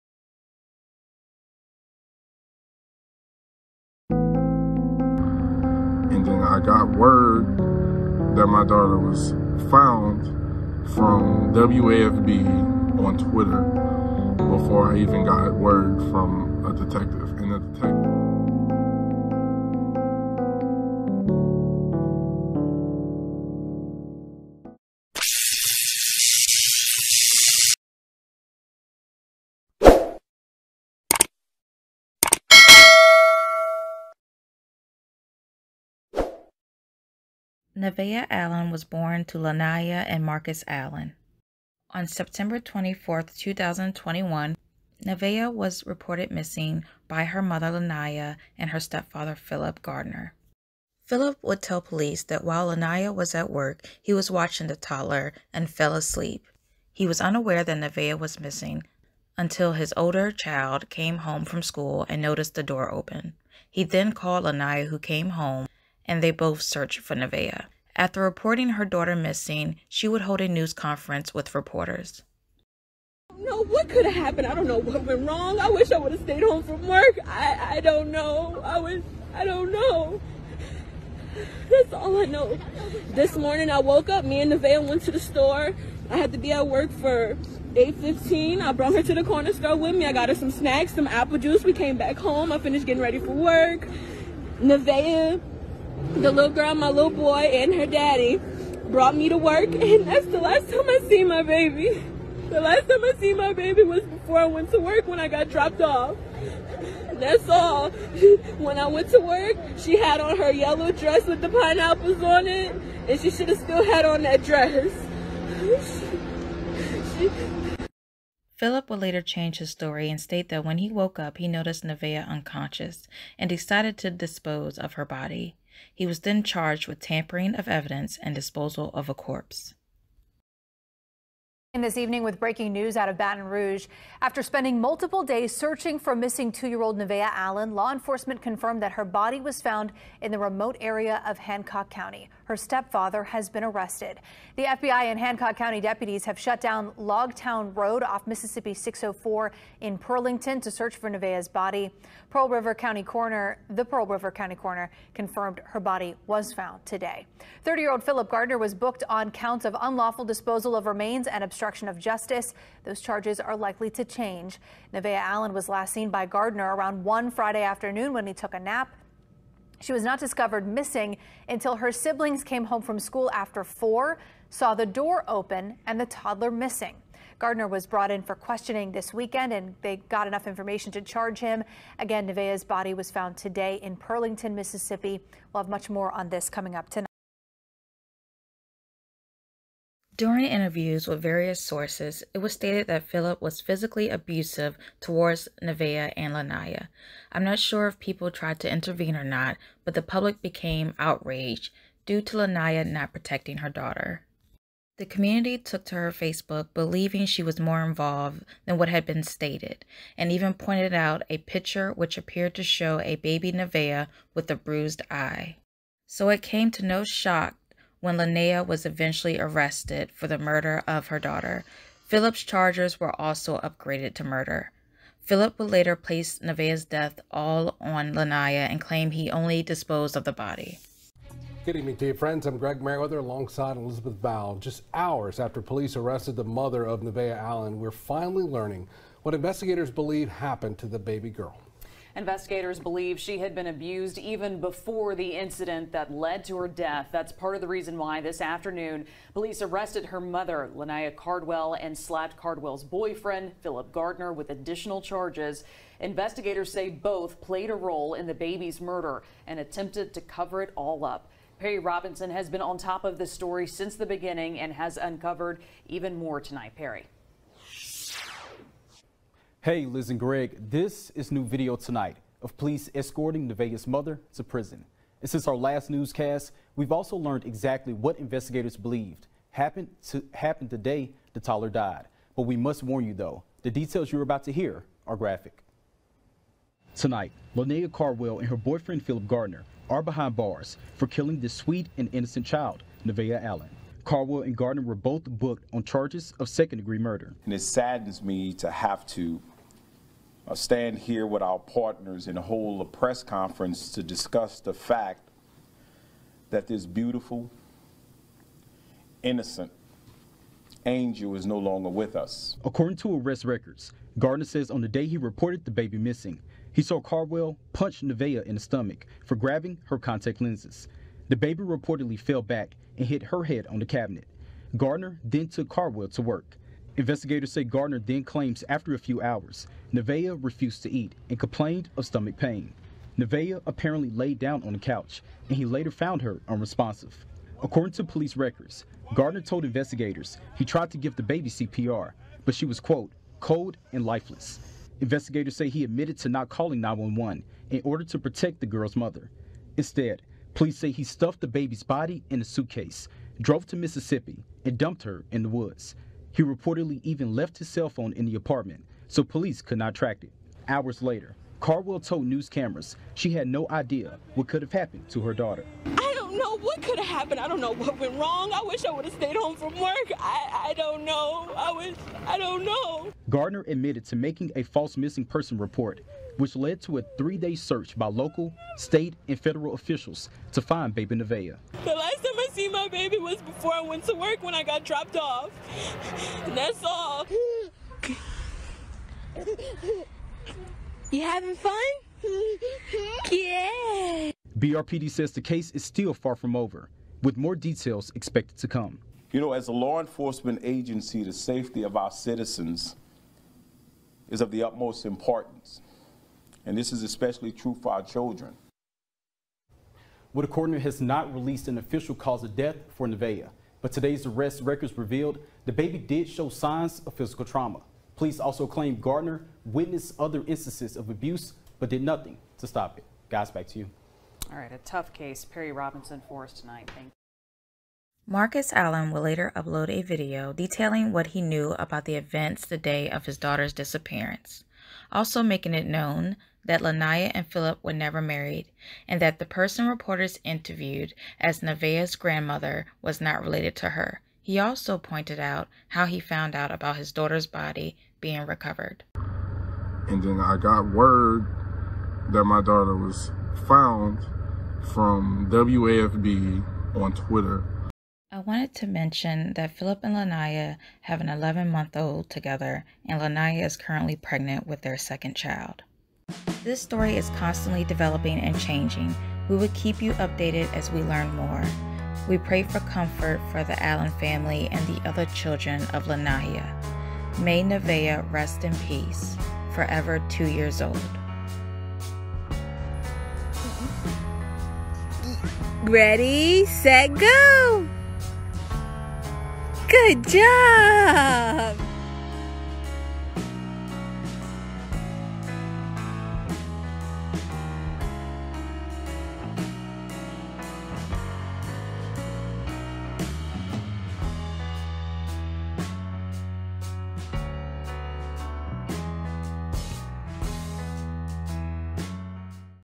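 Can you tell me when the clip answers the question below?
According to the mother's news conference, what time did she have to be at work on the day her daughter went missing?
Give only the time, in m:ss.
1:27.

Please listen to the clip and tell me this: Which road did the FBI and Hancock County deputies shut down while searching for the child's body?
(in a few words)
Logtown Road.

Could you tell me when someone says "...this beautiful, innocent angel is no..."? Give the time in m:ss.
5:06.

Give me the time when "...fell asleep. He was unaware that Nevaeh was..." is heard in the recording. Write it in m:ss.
0:55.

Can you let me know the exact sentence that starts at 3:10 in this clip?
During interviews with various sources, it was stated that Phillip was physically abusive towards Nevaeh and Lanaya.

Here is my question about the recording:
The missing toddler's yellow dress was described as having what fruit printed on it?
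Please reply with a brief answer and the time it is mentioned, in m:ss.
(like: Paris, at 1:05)
pineapples, at 1:51.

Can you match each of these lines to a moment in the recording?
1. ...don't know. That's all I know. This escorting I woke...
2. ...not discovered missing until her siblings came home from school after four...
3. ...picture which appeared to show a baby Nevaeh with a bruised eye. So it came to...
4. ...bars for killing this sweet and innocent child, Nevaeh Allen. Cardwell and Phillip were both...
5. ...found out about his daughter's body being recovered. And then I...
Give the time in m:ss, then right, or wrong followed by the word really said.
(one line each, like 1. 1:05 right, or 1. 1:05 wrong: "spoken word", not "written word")
1. 1:19 wrong: "morning", not "escorting"
2. 2:50 right
3. 3:31 right
4. 4:50 wrong: "Gardner", not "Phillip"
5. 7:26 right.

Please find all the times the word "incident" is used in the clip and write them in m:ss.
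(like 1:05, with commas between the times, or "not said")
4:05.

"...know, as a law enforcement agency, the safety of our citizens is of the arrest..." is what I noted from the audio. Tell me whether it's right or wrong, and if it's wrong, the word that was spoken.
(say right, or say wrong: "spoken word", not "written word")
wrong: "utmost", not "arrest".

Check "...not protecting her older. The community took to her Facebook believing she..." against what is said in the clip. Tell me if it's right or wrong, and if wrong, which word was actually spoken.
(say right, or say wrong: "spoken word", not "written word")
wrong: "daughter", not "older".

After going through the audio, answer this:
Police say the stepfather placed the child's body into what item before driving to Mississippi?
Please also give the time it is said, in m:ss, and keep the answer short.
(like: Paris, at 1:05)
suitcase, at 5:52.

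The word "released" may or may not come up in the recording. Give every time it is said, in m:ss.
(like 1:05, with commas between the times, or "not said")
6:51.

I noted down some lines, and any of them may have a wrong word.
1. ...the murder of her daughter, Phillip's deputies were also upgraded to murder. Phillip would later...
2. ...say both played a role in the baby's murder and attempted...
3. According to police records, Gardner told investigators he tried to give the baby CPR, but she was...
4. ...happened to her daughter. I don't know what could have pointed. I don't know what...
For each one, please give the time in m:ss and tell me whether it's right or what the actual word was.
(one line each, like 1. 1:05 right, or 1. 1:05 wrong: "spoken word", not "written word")
1. 3:40 wrong: "charges", not "deputies"
2. 4:16 right
3. 5:37 right
4. 6:04 wrong: "happened", not "pointed".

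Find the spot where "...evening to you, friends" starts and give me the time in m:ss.
3:51.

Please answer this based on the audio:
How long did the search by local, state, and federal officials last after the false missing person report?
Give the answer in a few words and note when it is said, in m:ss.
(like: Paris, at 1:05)
3 days, at 6:17.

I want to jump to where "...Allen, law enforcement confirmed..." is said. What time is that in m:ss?
2:17.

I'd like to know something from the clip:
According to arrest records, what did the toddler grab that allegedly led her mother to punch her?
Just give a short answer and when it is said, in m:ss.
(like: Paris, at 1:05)
contact lenses, at 5:19.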